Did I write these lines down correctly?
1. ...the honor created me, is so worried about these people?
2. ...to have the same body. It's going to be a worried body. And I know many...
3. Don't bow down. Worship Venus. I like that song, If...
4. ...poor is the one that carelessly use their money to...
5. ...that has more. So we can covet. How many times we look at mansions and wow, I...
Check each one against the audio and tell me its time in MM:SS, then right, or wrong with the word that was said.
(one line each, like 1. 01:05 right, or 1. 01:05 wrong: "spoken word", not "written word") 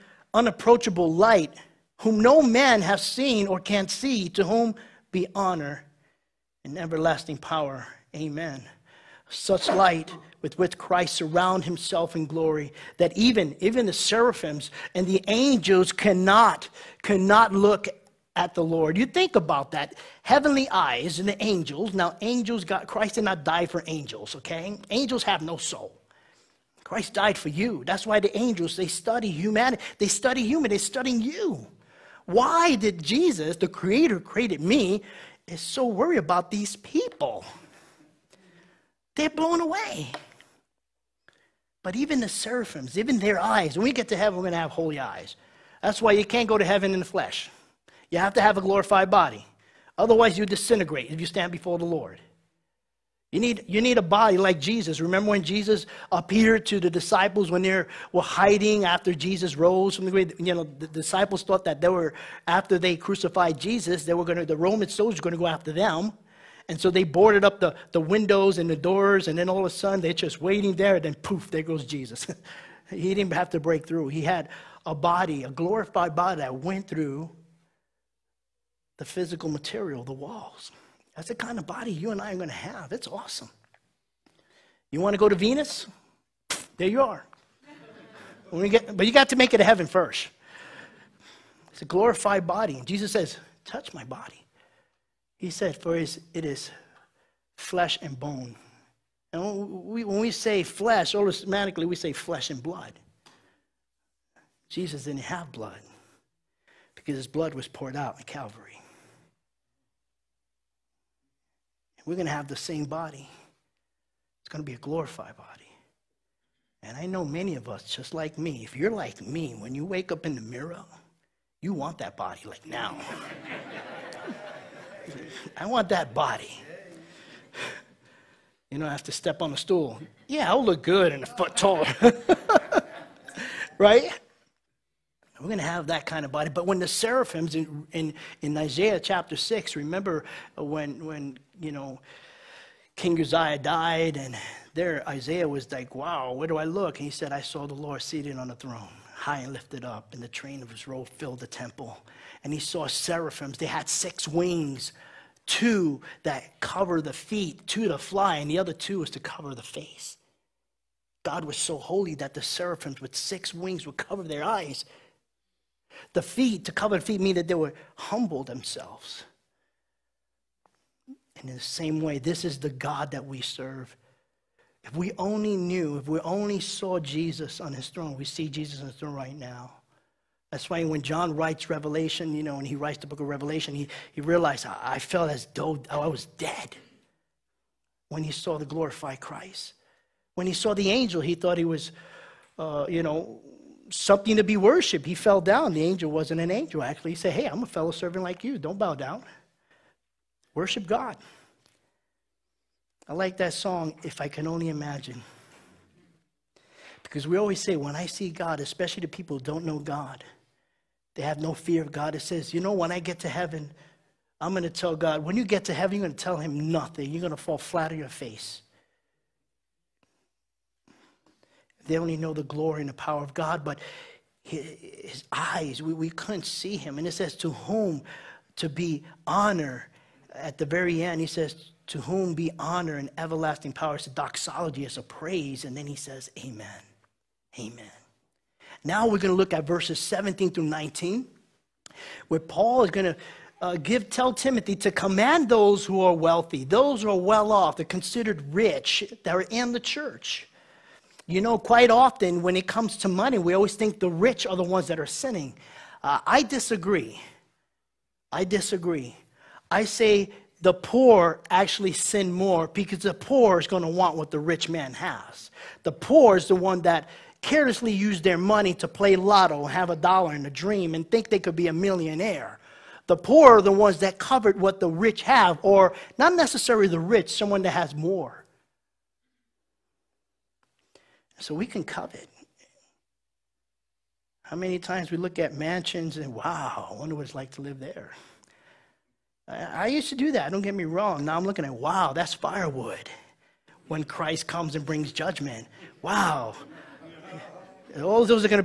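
1. 00:33 wrong: "creator", not "honor"
2. 01:52 wrong: "glorified", not "worried"
3. 03:18 wrong: "God", not "Venus"
4. 04:25 right
5. 04:37 right.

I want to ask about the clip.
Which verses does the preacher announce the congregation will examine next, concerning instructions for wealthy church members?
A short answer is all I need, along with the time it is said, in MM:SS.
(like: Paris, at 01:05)
17 through 19, at 03:59.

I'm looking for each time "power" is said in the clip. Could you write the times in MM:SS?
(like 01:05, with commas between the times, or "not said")
00:07, 03:42, 03:53.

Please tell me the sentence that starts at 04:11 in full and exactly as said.
You know, quite often when it comes to money, we always think the rich are the ones that are sinning.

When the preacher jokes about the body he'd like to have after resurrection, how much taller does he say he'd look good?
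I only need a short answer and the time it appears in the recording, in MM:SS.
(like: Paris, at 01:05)
a foot taller, at 02:11.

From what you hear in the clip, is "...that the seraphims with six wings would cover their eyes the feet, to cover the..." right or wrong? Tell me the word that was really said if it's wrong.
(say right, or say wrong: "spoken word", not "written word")
right.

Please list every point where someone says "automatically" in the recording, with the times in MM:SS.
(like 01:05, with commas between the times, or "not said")
01:41.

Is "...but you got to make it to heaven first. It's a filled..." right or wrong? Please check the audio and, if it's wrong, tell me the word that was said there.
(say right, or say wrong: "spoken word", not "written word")
wrong: "glorified", not "filled".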